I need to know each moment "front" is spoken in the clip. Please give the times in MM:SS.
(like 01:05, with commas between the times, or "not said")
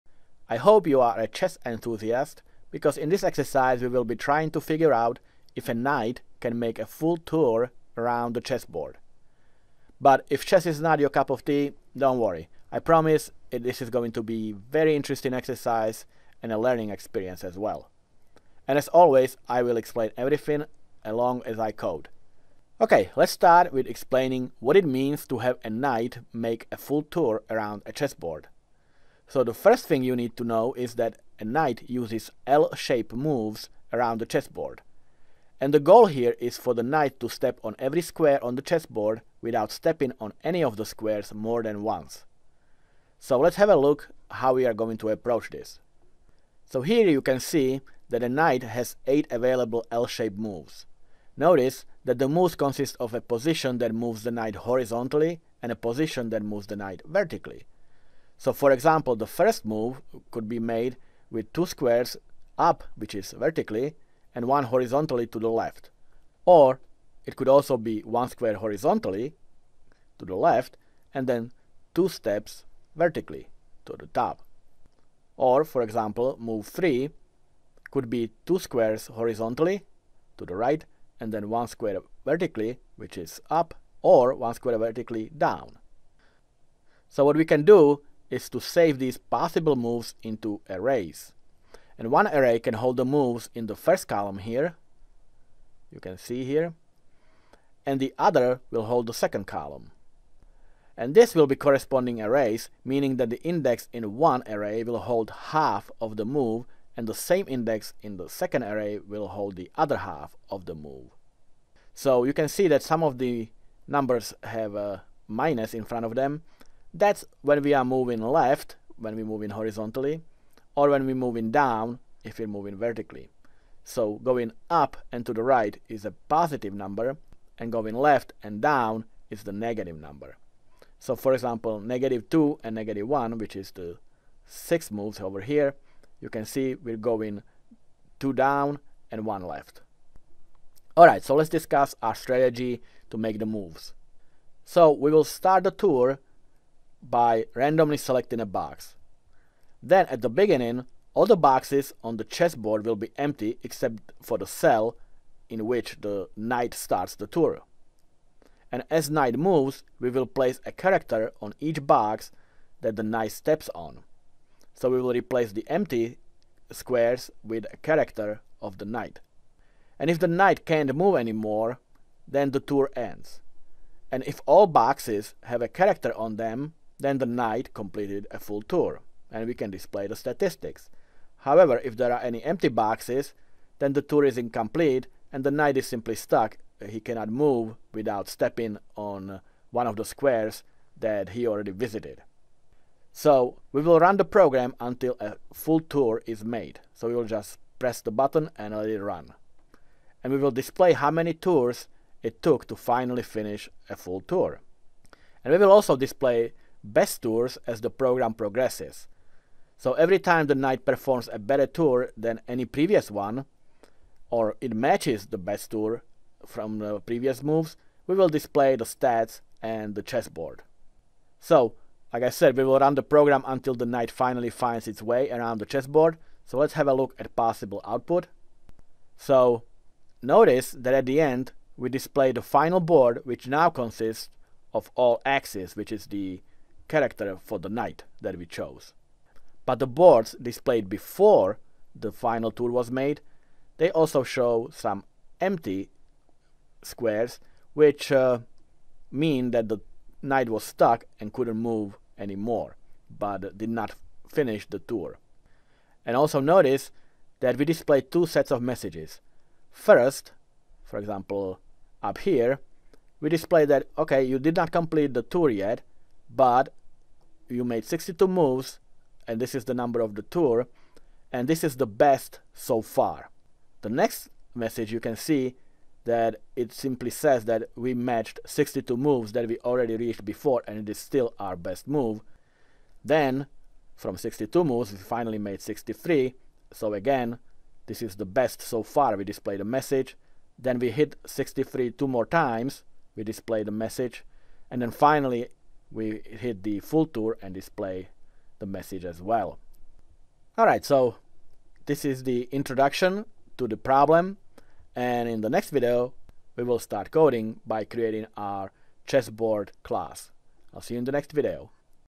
01:55.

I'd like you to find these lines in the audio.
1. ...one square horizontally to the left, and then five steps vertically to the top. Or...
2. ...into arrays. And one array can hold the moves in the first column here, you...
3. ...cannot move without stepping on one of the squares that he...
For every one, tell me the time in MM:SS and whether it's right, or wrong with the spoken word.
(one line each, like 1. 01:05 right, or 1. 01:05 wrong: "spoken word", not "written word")
1. 01:07 wrong: "two", not "five"
2. 01:30 right
3. 03:06 right.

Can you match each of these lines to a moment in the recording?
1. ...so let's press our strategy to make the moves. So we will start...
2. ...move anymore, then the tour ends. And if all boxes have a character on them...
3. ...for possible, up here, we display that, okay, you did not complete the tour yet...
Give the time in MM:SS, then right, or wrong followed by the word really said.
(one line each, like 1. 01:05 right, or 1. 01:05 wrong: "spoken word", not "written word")
1. 02:21 wrong: "discuss", not "press"
2. 02:50 right
3. 04:20 wrong: "example", not "possible".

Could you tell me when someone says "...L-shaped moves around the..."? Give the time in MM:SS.
00:32.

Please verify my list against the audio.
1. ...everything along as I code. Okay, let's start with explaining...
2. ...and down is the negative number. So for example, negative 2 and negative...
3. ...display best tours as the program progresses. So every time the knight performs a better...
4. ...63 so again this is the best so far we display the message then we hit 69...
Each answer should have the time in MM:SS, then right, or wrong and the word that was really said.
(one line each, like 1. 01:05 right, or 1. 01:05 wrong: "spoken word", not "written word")
1. 00:20 right
2. 02:08 right
3. 03:25 right
4. 04:45 wrong: "63", not "69".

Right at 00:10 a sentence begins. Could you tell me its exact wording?
But if chess is not your cup of tea, don't worry.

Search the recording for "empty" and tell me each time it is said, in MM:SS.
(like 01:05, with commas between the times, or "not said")
02:33, 02:45, 03:02, 04:05.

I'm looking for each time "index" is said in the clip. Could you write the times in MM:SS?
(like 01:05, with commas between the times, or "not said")
01:43, 01:47.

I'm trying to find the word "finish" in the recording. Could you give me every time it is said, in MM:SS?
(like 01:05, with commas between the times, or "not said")
03:23, 04:14.